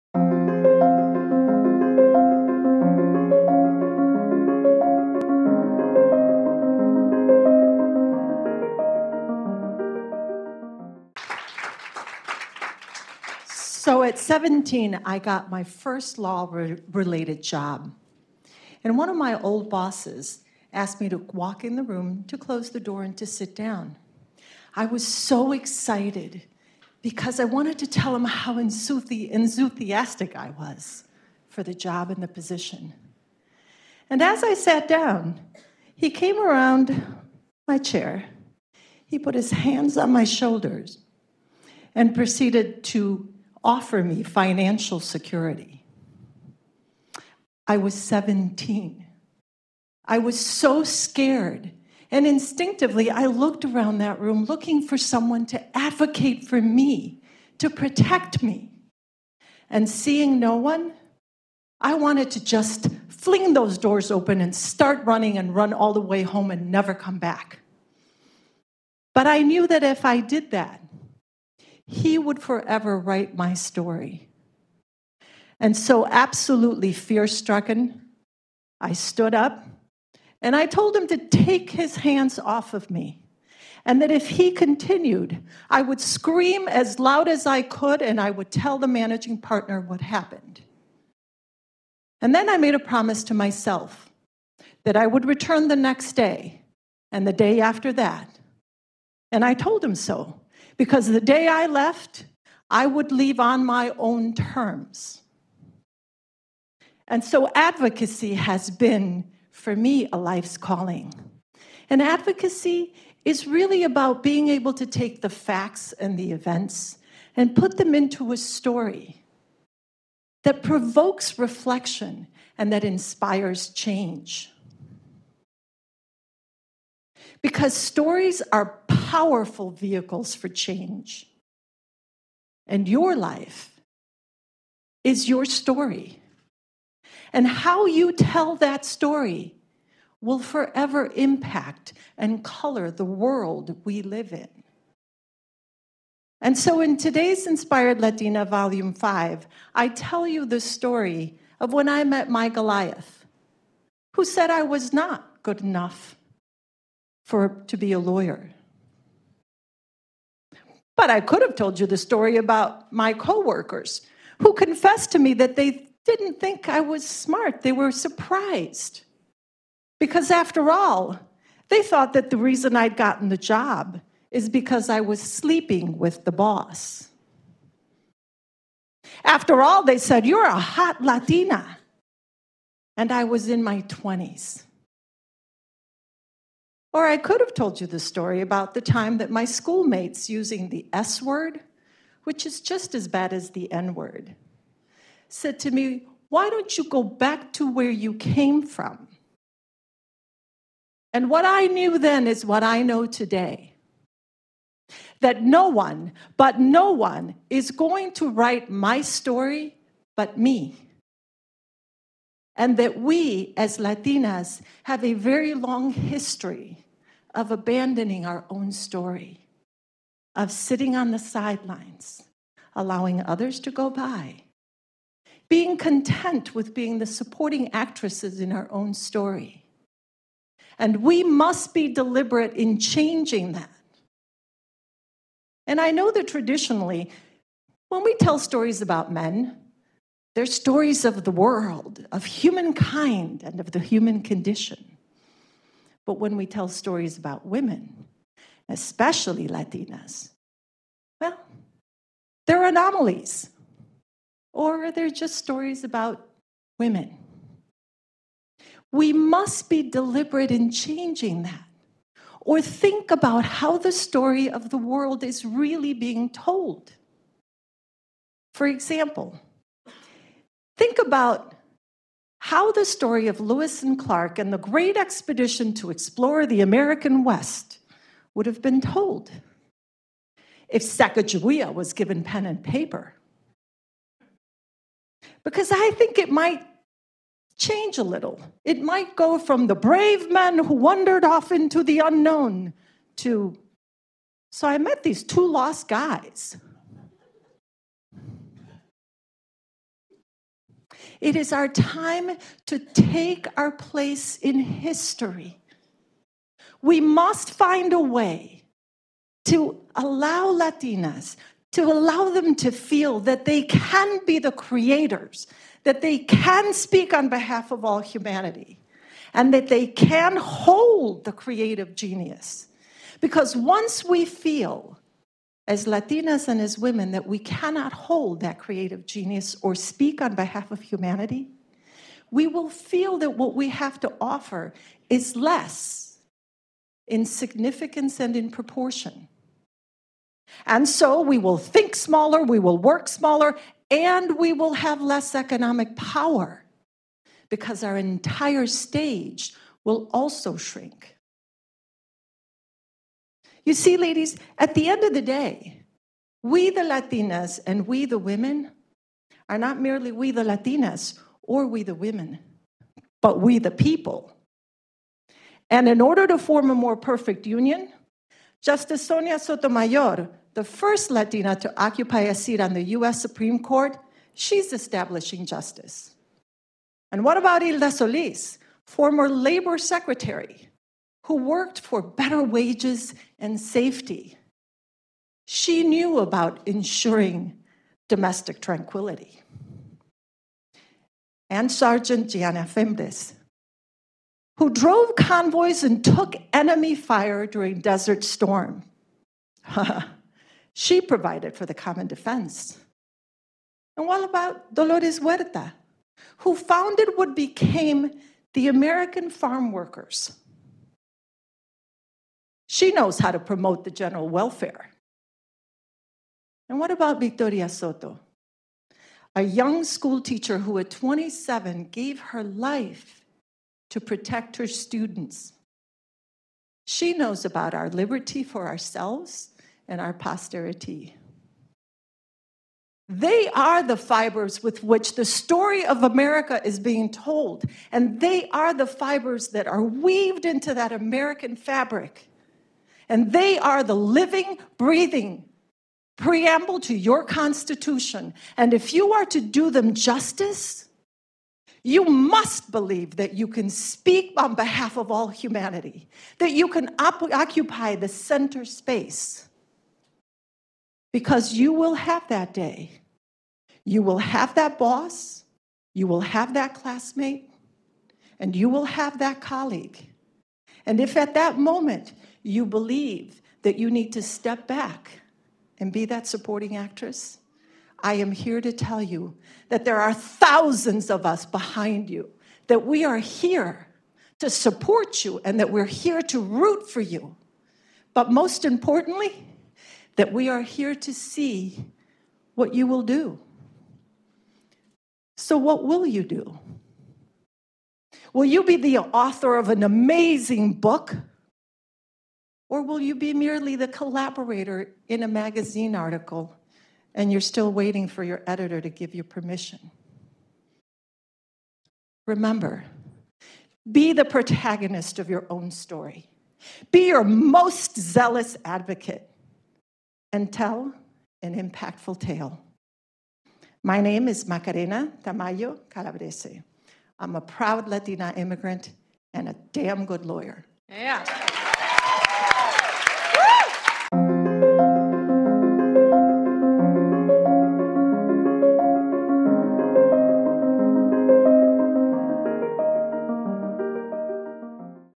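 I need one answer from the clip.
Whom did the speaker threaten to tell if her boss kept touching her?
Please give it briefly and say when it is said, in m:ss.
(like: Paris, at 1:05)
the managing partner, at 1:28.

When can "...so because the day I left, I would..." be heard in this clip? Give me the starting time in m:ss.
1:39.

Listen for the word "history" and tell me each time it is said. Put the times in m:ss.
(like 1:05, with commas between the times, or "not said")
3:35, 5:04.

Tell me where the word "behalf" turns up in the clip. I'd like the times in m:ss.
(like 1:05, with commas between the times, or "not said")
5:17, 5:30, 7:34.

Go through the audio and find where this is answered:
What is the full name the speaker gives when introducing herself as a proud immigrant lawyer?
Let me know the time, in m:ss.
8:44.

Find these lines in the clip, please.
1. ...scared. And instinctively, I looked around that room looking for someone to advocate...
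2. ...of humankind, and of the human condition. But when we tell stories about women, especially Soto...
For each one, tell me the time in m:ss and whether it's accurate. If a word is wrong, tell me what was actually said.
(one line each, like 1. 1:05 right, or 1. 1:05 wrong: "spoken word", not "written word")
1. 0:50 right
2. 4:02 wrong: "Latinas", not "Soto".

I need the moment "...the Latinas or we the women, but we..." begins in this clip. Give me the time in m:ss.
6:00.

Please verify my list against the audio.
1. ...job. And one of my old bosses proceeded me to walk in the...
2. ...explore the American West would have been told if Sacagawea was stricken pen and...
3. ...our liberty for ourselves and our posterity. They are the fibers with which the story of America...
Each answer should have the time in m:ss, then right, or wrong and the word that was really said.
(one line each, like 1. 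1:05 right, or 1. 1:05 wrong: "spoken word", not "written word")
1. 0:17 wrong: "asked", not "proceeded"
2. 4:35 wrong: "given", not "stricken"
3. 7:07 right.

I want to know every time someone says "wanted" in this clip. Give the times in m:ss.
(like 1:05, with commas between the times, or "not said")
0:27, 1:01.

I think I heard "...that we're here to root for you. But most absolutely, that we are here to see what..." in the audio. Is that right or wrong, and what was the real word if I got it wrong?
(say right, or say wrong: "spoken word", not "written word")
wrong: "importantly", not "absolutely".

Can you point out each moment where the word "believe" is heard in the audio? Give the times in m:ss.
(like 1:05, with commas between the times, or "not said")
7:32, 7:52.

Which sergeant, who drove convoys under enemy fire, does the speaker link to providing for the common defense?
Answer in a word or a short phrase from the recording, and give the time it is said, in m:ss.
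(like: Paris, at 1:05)
Gianna Fimbres, at 6:32.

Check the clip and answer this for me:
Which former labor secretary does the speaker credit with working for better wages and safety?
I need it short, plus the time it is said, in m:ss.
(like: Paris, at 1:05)
Hilda Solis, at 6:17.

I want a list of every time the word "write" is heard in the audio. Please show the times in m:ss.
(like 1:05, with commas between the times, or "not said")
1:12, 3:28.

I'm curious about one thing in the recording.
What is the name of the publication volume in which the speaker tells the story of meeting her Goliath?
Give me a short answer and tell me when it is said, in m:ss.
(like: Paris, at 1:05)
Inspired Latina Volume 5, at 2:27.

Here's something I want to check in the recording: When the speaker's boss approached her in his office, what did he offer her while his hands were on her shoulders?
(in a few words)
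financial security.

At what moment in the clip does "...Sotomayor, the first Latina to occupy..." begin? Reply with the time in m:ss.
6:09.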